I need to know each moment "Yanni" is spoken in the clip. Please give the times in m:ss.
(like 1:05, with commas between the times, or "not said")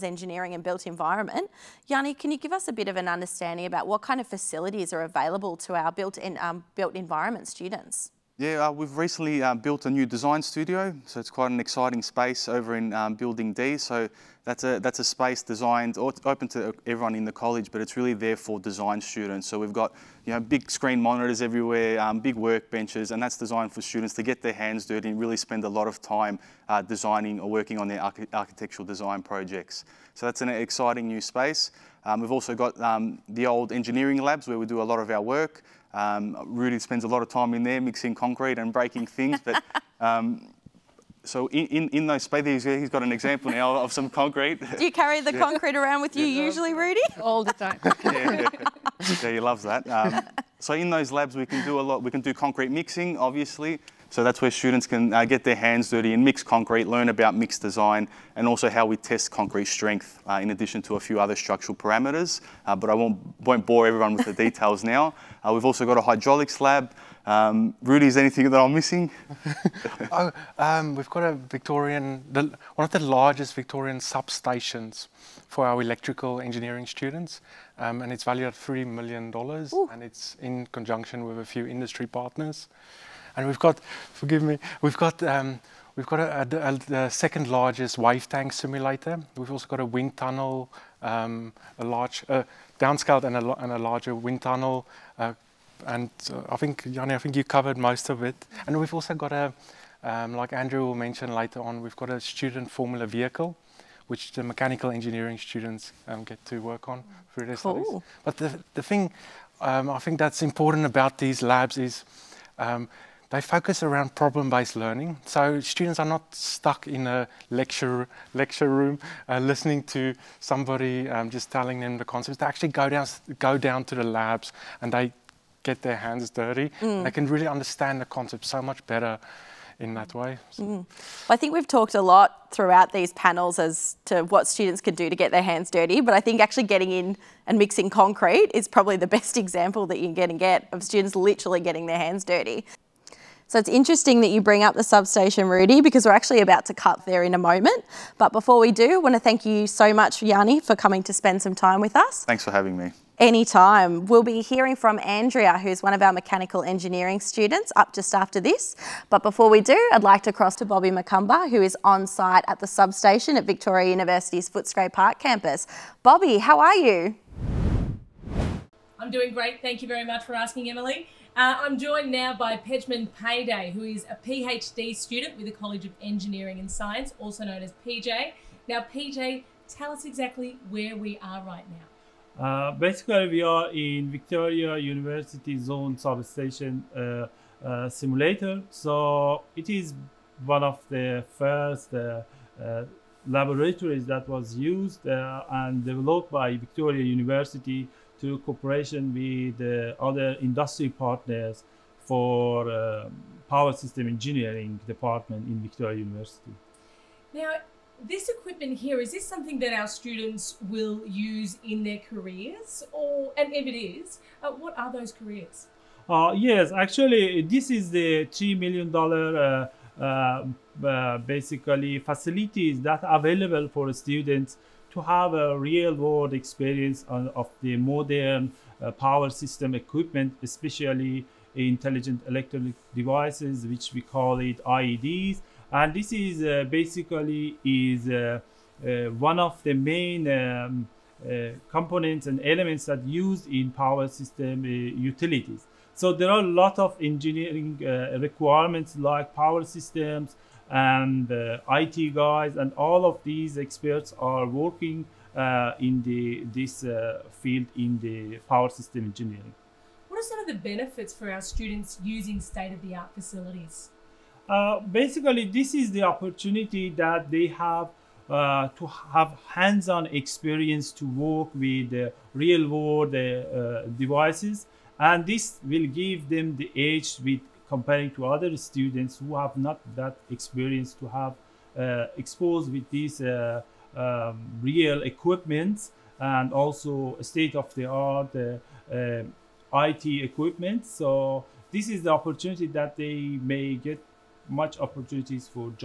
0:01, 1:36, 2:30.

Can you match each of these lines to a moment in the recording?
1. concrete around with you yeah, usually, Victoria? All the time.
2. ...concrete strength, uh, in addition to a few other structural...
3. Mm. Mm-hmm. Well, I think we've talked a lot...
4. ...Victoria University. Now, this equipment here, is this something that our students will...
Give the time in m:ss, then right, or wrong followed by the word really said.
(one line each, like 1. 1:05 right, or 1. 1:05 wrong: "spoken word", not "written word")
1. 0:45 wrong: "Rudy", not "Victoria"
2. 0:59 right
3. 2:10 right
4. 3:25 right.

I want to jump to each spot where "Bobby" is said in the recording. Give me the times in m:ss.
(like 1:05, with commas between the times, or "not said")
2:40, 2:46.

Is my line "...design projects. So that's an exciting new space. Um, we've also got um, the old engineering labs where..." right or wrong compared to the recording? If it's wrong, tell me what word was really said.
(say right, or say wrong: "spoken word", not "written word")
right.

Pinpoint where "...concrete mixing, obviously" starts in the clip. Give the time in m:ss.
0:52.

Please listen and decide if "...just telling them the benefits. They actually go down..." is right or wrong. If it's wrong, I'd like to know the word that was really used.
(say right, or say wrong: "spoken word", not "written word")
wrong: "concepts", not "benefits".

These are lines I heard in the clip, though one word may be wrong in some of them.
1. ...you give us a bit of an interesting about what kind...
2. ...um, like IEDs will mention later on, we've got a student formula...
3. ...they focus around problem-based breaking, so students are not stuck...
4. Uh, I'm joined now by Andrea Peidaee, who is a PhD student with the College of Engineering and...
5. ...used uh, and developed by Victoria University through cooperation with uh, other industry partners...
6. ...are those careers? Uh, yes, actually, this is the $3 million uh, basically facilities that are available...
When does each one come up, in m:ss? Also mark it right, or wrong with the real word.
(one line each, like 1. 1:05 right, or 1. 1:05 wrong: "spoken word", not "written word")
1. 0:02 wrong: "understanding", not "interesting"
2. 1:40 wrong: "Andrew", not "IEDs"
3. 1:53 wrong: "learning", not "breaking"
4. 2:51 wrong: "Pejman", not "Andrea"
5. 3:14 right
6. 3:34 right.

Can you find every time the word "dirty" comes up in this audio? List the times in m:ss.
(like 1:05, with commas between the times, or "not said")
0:24, 0:55, 2:06, 2:15, 2:22.